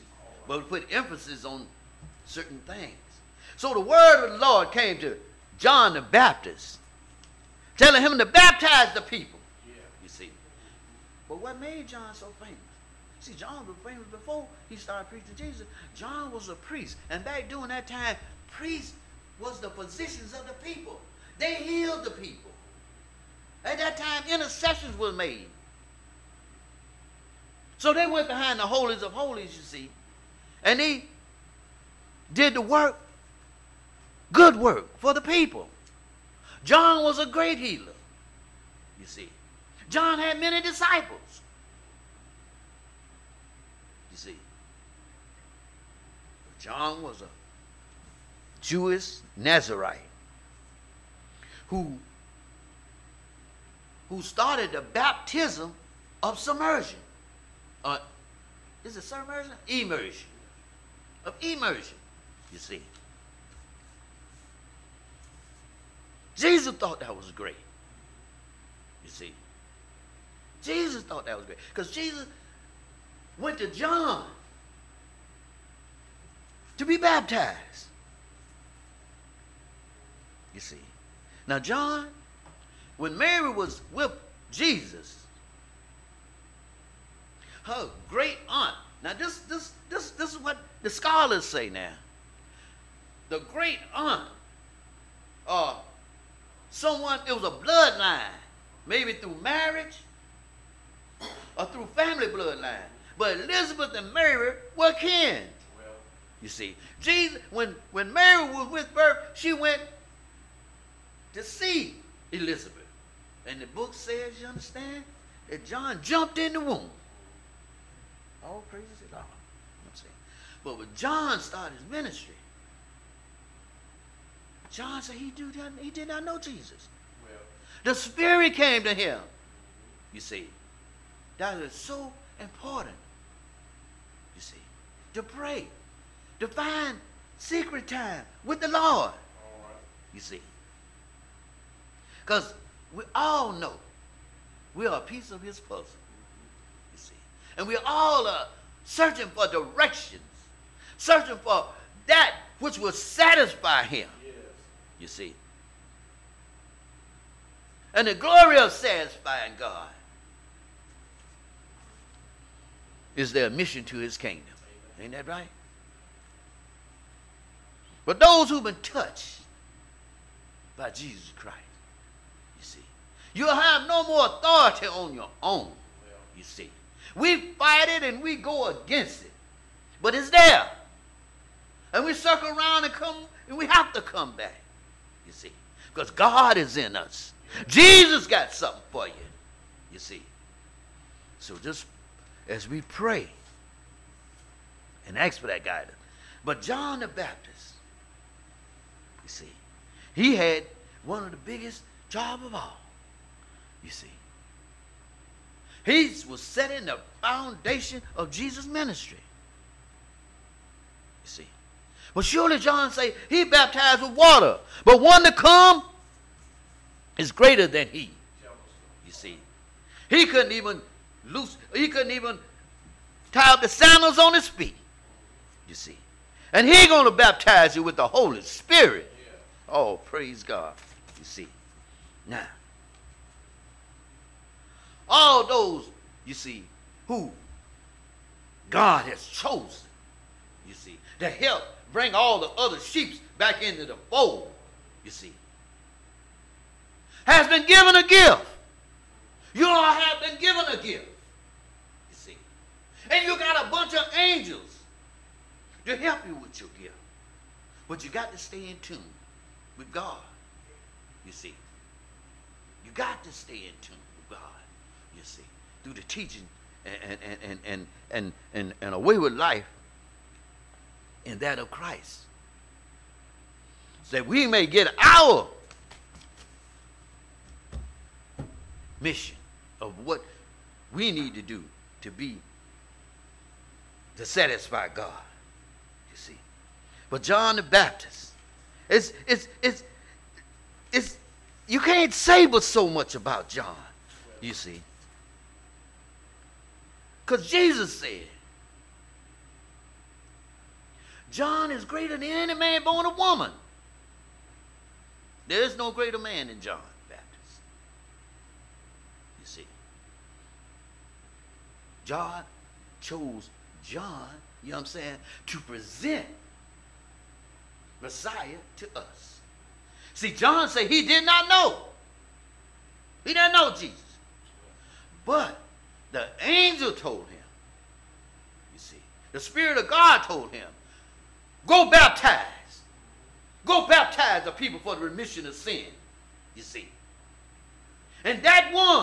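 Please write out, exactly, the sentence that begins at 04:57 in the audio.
Because Jesus said, John is greater than any man born of woman.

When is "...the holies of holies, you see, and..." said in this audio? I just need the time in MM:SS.
00:28.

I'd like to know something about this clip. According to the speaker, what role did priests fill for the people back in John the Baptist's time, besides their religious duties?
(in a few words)
Physicians.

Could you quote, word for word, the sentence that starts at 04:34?
So that we may get our mission of what we need to do to be to satisfy God.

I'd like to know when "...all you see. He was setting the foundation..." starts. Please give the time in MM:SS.
03:22.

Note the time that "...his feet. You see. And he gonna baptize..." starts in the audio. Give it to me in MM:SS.
03:44.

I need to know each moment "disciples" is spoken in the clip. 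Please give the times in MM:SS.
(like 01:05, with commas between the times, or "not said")
00:40.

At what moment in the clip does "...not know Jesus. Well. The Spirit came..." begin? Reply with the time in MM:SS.
02:06.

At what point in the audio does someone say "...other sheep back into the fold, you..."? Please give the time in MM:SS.
04:02.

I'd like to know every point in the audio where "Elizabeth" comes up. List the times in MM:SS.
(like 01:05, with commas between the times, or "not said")
01:43, 01:52.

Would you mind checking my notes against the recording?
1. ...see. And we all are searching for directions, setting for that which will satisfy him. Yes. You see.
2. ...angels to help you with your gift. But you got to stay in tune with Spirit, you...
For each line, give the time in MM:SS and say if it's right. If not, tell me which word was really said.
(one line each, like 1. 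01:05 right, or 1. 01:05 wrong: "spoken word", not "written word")
1. 02:26 wrong: "searching", not "setting"
2. 04:14 wrong: "God", not "Spirit".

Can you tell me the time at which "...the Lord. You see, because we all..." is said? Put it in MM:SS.
02:18.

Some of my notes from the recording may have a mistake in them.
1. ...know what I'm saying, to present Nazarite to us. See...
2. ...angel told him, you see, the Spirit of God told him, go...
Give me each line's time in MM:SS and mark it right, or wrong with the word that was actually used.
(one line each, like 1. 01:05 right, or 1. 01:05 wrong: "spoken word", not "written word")
1. 05:14 wrong: "Messiah", not "Nazarite"
2. 05:26 right.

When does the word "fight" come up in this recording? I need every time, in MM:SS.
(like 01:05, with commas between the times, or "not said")
02:57.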